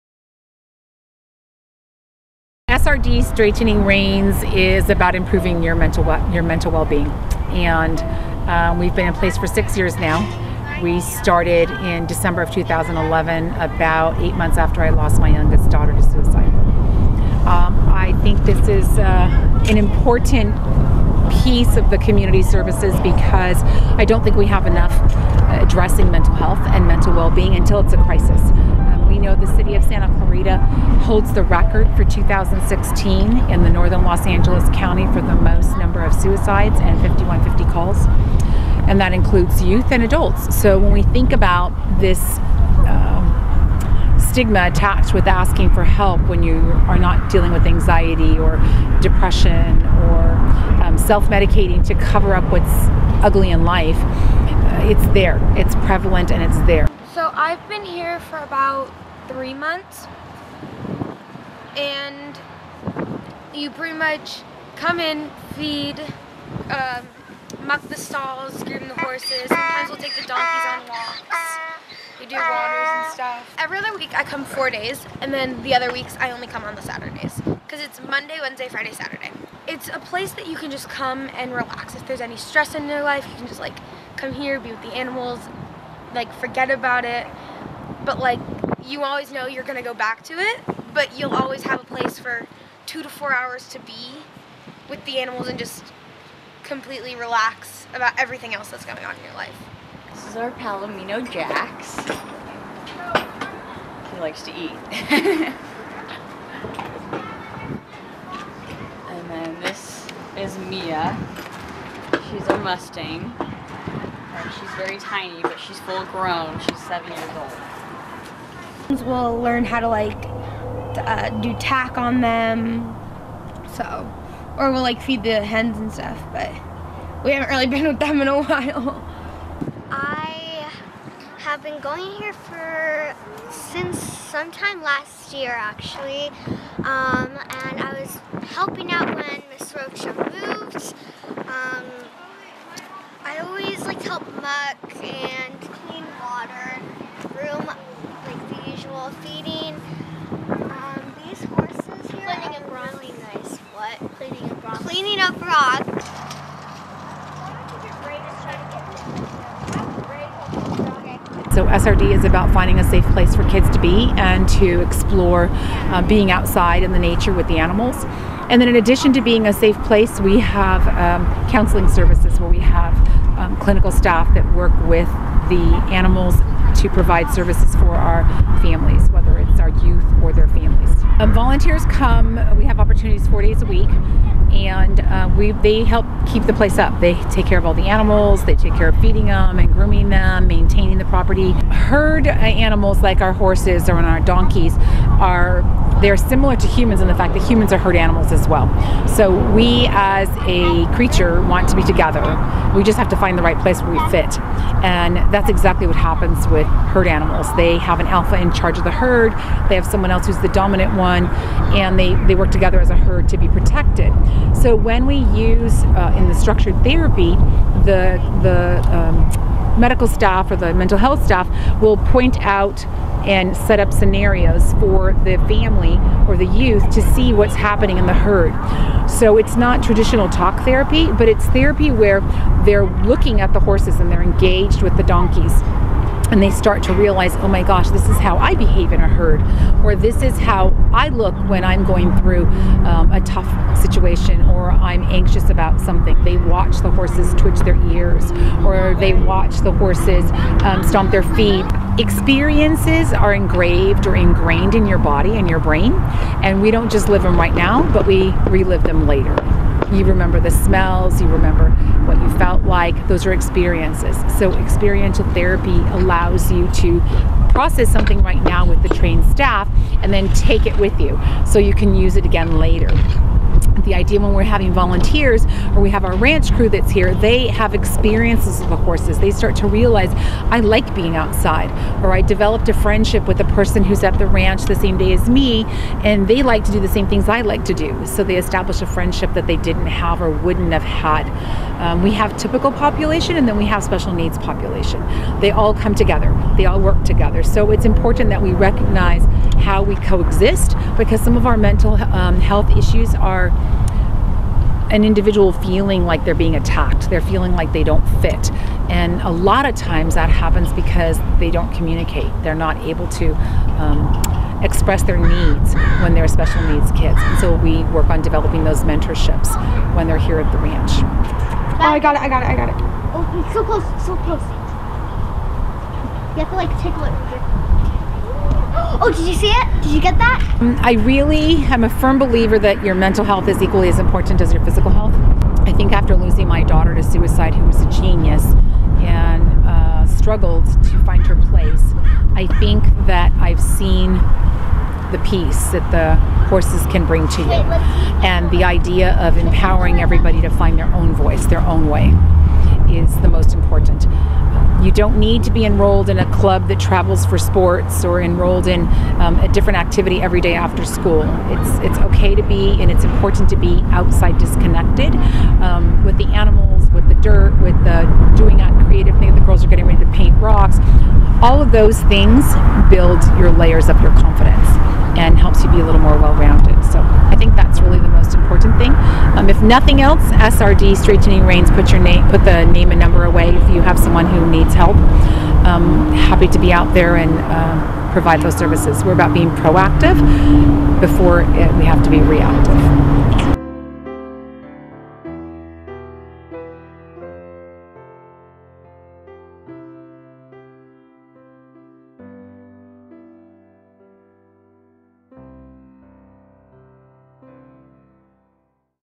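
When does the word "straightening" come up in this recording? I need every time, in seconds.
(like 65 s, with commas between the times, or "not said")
3 s, 380 s.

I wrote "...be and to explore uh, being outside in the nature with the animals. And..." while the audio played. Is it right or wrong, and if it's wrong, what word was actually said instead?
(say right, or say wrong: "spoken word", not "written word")
right.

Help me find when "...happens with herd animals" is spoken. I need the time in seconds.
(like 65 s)
205 s.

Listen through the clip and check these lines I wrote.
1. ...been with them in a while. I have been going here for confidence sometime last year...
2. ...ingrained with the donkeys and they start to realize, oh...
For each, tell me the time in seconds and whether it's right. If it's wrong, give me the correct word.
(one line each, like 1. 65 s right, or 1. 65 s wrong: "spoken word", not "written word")
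1. 127 s wrong: "since", not "confidence"
2. 234 s wrong: "engaged", not "ingrained".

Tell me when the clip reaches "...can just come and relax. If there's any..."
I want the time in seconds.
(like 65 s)
80 s.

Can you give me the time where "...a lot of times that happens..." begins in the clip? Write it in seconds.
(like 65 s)
309 s.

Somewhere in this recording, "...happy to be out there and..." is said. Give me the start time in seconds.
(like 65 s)
386 s.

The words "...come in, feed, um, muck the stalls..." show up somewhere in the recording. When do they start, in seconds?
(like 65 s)
64 s.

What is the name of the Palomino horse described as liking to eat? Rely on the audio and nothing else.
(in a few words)
Jax.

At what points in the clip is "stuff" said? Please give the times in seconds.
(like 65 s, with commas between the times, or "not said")
73 s, 125 s.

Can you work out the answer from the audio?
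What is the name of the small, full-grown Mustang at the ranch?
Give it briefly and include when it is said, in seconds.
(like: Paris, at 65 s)
Mia, at 110 s.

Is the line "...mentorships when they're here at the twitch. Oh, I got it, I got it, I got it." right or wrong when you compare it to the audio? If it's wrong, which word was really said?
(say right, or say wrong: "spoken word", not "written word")
wrong: "ranch", not "twitch".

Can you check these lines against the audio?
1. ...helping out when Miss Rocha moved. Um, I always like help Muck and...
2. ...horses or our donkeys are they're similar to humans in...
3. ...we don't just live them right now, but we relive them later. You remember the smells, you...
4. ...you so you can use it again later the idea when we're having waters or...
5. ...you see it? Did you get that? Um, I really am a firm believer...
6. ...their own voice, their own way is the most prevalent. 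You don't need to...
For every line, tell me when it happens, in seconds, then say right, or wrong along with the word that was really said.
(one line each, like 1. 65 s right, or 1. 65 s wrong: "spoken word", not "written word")
1. 138 s right
2. 193 s right
3. 256 s right
4. 270 s wrong: "volunteers", not "waters"
5. 329 s right
6. 350 s wrong: "important", not "prevalent".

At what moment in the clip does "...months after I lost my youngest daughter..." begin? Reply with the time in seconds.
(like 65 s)
14 s.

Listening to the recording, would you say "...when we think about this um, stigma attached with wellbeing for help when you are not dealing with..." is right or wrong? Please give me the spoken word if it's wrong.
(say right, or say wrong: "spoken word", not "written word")
wrong: "asking", not "wellbeing".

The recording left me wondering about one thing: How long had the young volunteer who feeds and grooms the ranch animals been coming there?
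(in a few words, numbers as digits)
three months.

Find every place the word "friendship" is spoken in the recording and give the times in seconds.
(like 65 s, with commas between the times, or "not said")
282 s, 288 s.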